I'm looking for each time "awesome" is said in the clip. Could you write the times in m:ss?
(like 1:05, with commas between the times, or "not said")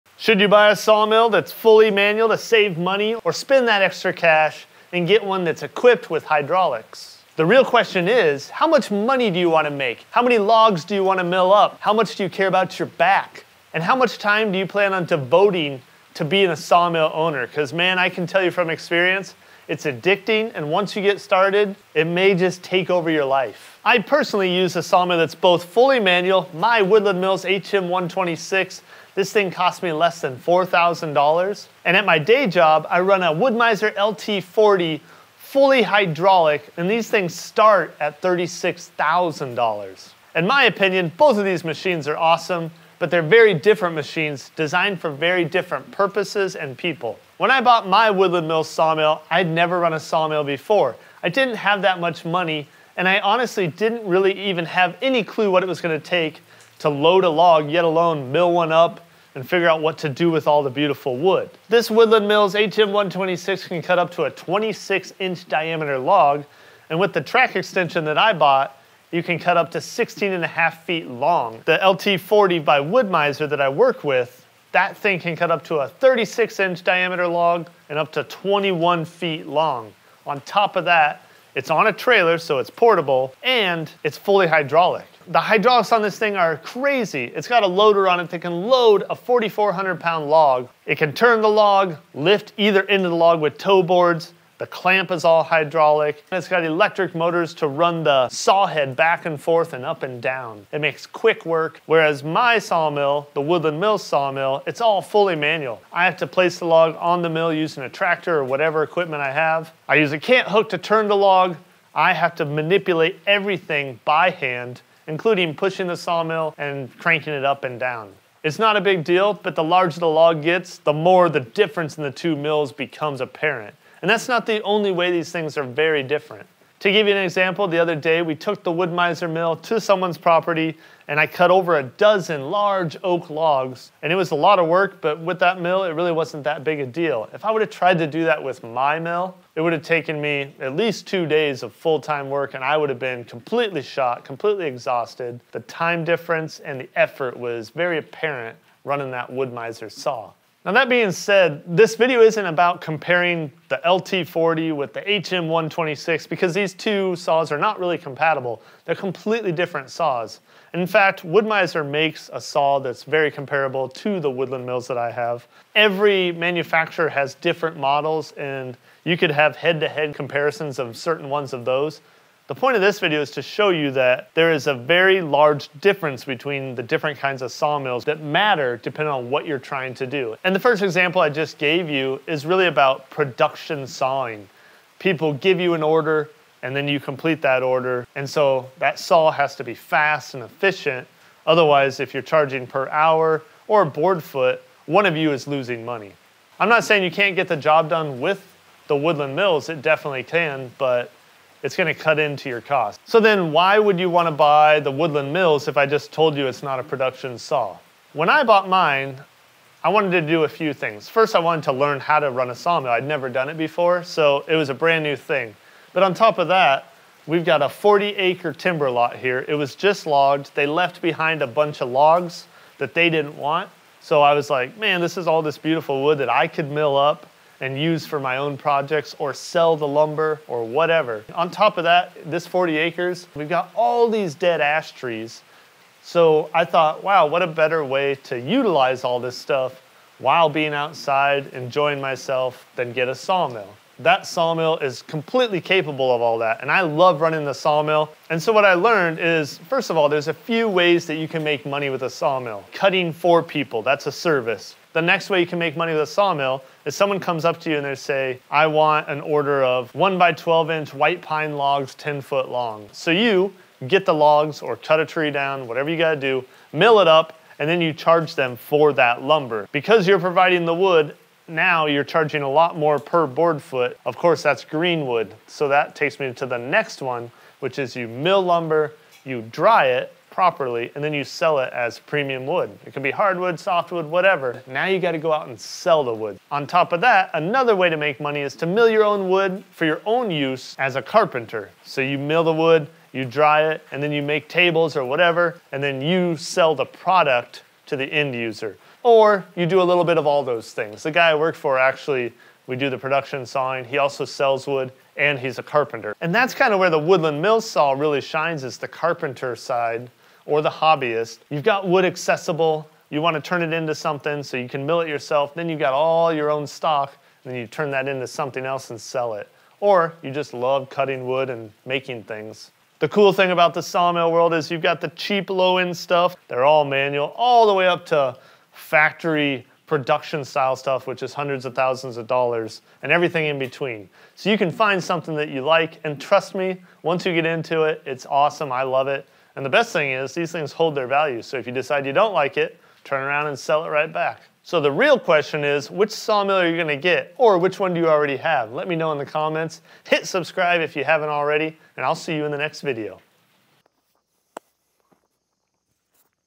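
0:42, 5:38.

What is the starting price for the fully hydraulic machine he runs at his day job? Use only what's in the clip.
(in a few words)
$36,000.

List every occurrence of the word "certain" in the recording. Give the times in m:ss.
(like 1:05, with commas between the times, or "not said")
2:50.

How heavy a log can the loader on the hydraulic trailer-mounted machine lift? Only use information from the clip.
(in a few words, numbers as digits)
4,400 pounds.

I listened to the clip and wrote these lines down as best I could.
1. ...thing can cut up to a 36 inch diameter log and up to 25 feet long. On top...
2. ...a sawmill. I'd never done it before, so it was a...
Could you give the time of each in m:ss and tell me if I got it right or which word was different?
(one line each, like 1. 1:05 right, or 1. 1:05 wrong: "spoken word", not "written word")
1. 1:14 wrong: "21", not "25"
2. 3:32 right.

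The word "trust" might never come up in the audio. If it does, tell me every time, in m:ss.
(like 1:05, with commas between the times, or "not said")
5:36.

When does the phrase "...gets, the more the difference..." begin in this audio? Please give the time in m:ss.
2:00.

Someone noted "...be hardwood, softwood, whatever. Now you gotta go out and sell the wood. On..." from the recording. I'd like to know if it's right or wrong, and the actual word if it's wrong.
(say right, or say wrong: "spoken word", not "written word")
right.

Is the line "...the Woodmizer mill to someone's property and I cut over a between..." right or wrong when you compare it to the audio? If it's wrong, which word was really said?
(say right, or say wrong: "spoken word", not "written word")
wrong: "dozen", not "between".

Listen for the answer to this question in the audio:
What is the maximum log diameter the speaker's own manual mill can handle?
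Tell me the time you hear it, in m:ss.
1:04.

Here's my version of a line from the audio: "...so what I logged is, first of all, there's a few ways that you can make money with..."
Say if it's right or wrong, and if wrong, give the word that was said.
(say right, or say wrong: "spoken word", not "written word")
wrong: "learned", not "logged".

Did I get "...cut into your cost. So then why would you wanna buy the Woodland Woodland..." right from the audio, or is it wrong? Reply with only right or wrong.
wrong.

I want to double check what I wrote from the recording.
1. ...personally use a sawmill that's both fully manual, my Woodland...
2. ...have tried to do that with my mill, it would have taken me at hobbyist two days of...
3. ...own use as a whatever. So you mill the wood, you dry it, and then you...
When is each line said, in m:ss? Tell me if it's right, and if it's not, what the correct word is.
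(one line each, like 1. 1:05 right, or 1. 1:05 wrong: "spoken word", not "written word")
1. 0:23 right
2. 2:17 wrong: "least", not "hobbyist"
3. 4:50 wrong: "carpenter", not "whatever".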